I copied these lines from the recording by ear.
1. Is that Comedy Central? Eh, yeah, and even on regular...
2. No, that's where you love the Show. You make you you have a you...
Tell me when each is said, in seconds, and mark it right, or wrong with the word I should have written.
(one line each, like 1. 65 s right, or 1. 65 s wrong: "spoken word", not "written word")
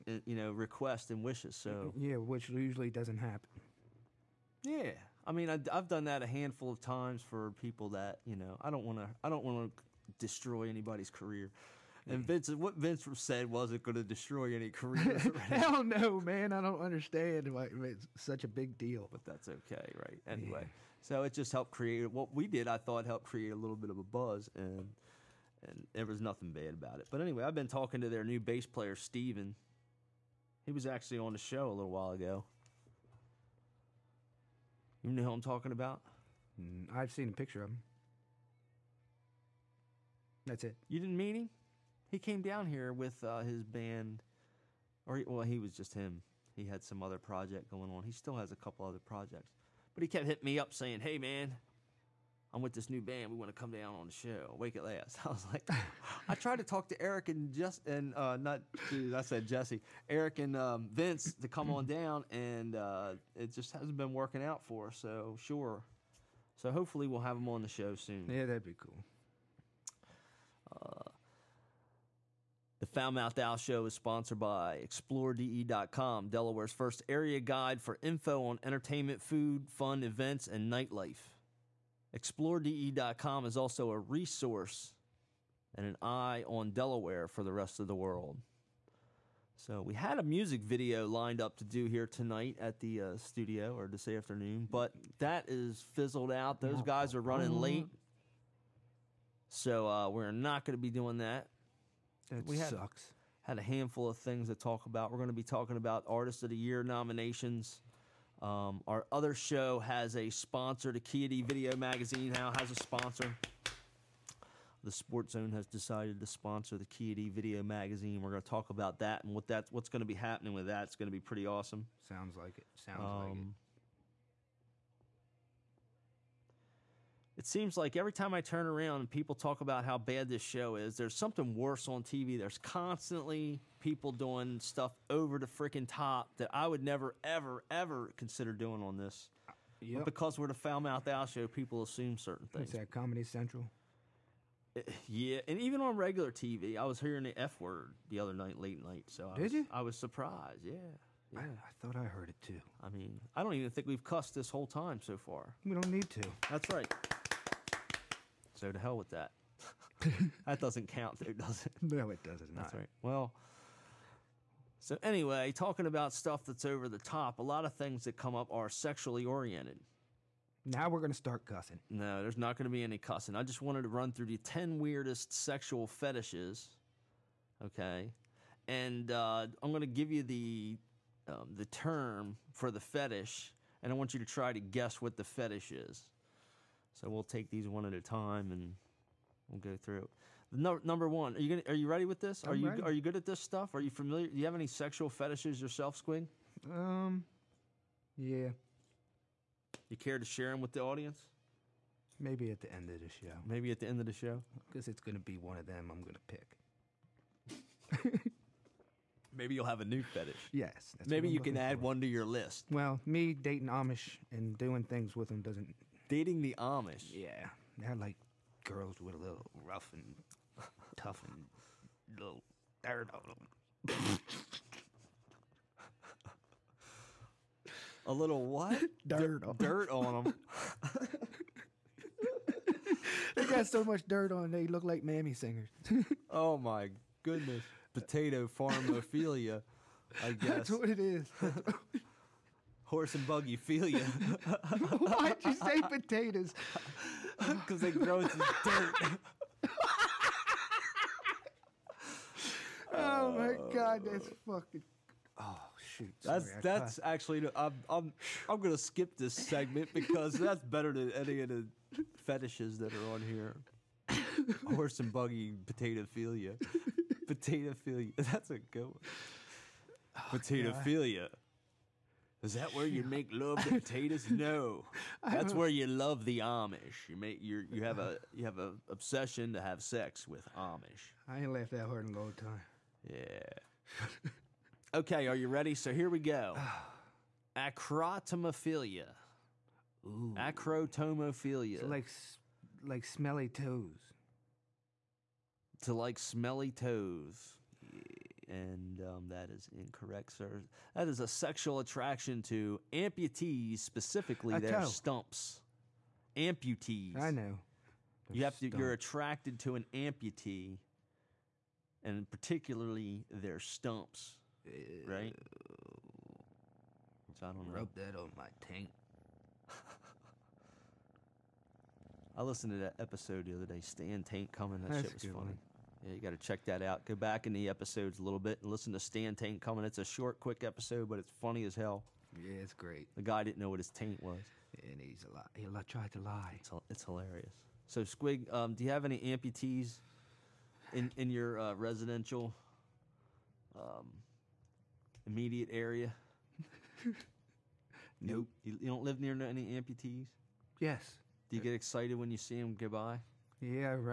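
1. 142 s right
2. 274 s wrong: "Amish", not "Show".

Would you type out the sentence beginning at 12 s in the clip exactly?
And Vince, what Vince said wasn't going to destroy any careers.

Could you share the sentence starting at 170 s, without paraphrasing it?
Now we're going to start cussing.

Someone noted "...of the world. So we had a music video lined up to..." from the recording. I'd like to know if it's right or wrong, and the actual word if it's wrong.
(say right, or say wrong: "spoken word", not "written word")
right.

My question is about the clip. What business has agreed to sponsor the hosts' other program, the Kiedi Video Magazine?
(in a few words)
The Sports Zone.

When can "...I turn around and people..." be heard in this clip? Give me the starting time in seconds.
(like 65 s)
128 s.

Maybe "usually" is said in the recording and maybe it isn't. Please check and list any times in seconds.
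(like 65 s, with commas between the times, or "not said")
2 s.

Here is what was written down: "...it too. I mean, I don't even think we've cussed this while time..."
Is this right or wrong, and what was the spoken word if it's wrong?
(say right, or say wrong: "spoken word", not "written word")
wrong: "whole", not "while".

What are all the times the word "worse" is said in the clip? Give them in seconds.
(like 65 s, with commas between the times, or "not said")
131 s.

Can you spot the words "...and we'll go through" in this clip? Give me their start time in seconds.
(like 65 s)
188 s.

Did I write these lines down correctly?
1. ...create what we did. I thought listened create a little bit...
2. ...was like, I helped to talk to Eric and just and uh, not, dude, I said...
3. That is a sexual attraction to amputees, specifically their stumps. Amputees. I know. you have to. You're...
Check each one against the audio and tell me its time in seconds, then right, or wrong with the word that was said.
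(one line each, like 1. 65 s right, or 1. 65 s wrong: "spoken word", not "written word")
1. 21 s wrong: "helped", not "listened"
2. 55 s wrong: "tried", not "helped"
3. 300 s right.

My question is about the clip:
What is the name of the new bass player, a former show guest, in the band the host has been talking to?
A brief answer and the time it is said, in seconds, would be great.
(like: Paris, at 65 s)
Steven, at 28 s.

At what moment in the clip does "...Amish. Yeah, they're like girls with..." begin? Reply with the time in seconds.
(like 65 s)
216 s.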